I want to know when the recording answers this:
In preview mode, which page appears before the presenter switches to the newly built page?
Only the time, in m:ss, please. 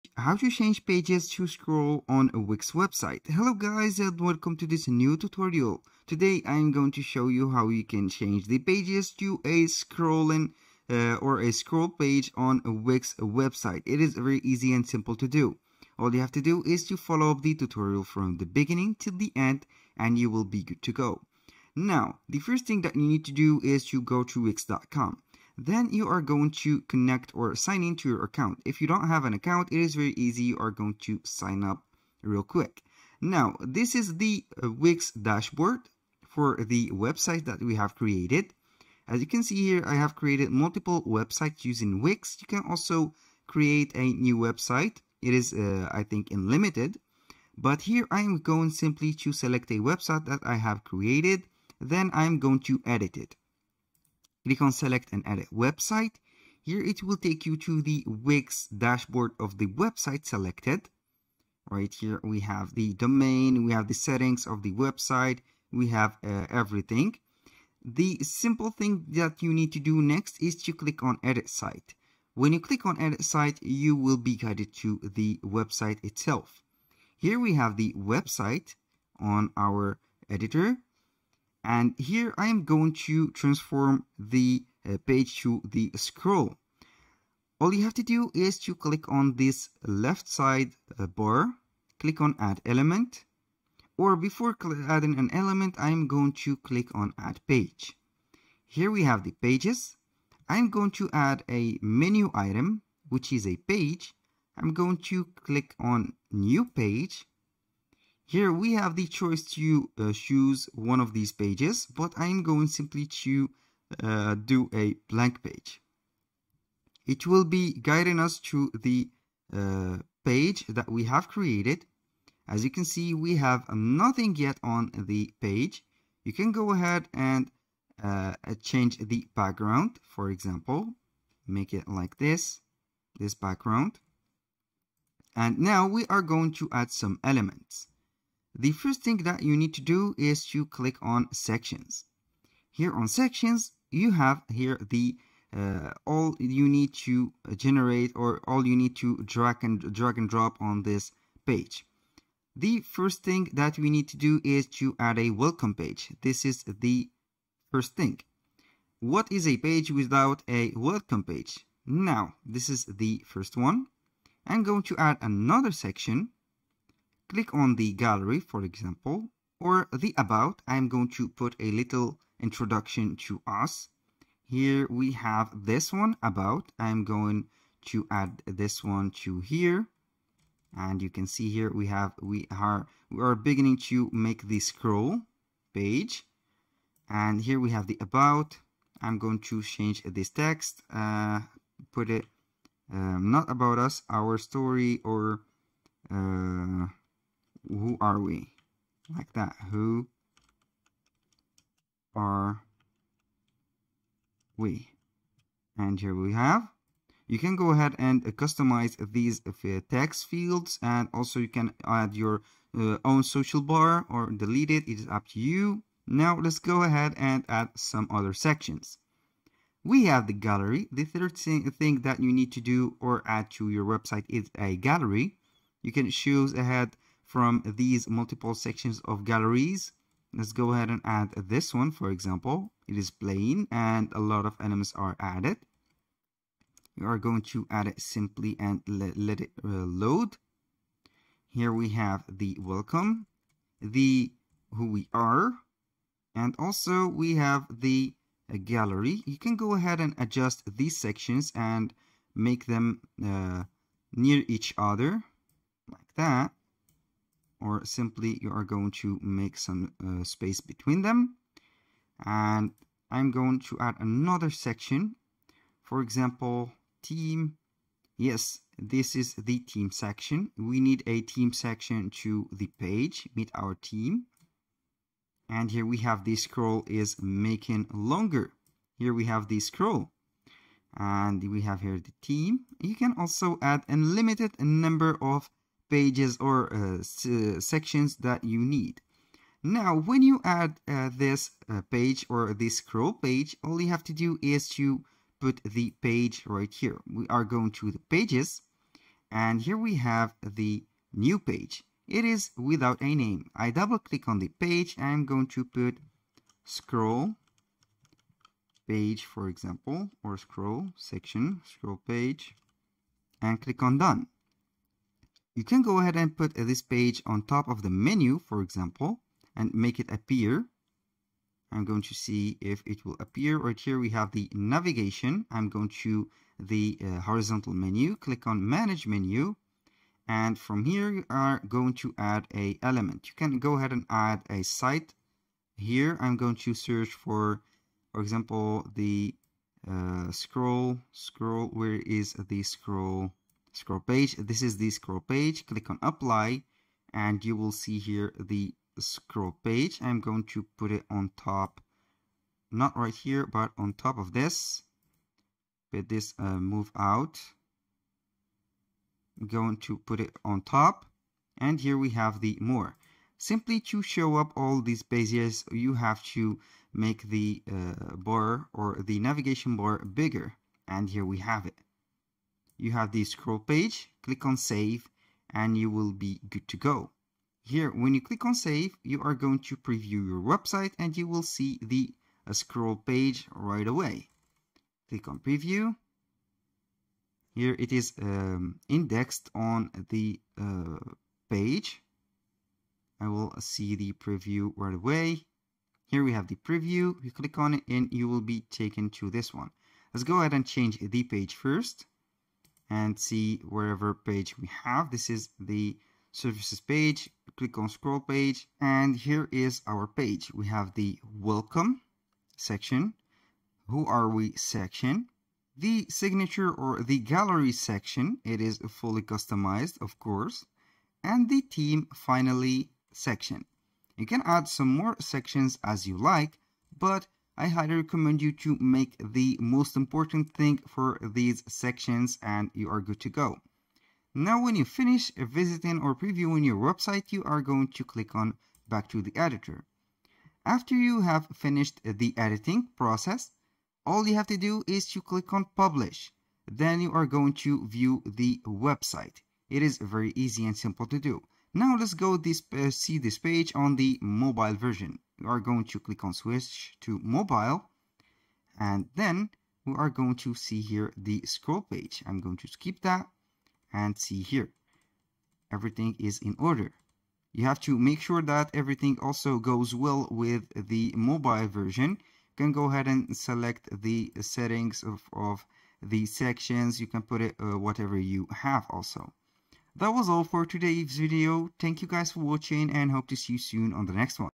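6:46.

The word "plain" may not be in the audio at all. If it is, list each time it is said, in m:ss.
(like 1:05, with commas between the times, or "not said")
3:53.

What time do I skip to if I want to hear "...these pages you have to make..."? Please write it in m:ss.
6:04.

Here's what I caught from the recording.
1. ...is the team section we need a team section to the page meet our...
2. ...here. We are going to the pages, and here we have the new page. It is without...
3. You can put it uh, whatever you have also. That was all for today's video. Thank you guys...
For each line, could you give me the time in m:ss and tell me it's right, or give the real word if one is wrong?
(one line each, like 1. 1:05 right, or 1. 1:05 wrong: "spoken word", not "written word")
1. 4:29 right
2. 4:56 right
3. 7:57 right.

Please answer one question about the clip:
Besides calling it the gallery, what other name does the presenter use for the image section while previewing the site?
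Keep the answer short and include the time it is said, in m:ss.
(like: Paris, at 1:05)
Signature, at 6:56.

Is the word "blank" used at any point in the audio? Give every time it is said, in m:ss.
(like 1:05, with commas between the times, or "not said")
1:55.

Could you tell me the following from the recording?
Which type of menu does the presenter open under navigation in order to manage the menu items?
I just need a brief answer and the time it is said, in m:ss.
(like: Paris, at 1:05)
Horizontal menu, at 5:27.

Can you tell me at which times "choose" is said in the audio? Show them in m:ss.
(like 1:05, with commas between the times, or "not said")
1:50, 3:46.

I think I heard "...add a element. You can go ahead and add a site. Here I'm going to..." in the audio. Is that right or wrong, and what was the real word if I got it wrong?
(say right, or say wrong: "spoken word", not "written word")
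right.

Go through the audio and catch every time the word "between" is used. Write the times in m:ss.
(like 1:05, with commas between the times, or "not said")
4:20.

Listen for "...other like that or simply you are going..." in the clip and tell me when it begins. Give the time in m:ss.
4:14.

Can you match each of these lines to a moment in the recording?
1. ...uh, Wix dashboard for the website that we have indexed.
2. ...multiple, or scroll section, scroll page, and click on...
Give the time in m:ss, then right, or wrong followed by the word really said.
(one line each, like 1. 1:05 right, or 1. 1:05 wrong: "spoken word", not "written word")
1. 0:34 wrong: "created", not "indexed"
2. 5:09 wrong: "example", not "multiple".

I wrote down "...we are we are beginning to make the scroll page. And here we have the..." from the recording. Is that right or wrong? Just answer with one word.
right.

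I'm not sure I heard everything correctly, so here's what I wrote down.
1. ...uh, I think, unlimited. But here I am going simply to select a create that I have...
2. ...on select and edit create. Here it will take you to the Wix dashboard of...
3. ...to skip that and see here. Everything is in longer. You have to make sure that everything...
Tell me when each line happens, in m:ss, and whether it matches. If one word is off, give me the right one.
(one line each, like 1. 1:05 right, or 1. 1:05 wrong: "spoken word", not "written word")
1. 0:45 wrong: "website", not "create"
2. 0:54 wrong: "website", not "create"
3. 7:42 wrong: "order", not "longer".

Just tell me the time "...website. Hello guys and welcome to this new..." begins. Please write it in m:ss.
0:02.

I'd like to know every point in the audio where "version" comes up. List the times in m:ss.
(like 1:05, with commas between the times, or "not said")
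7:34, 7:51.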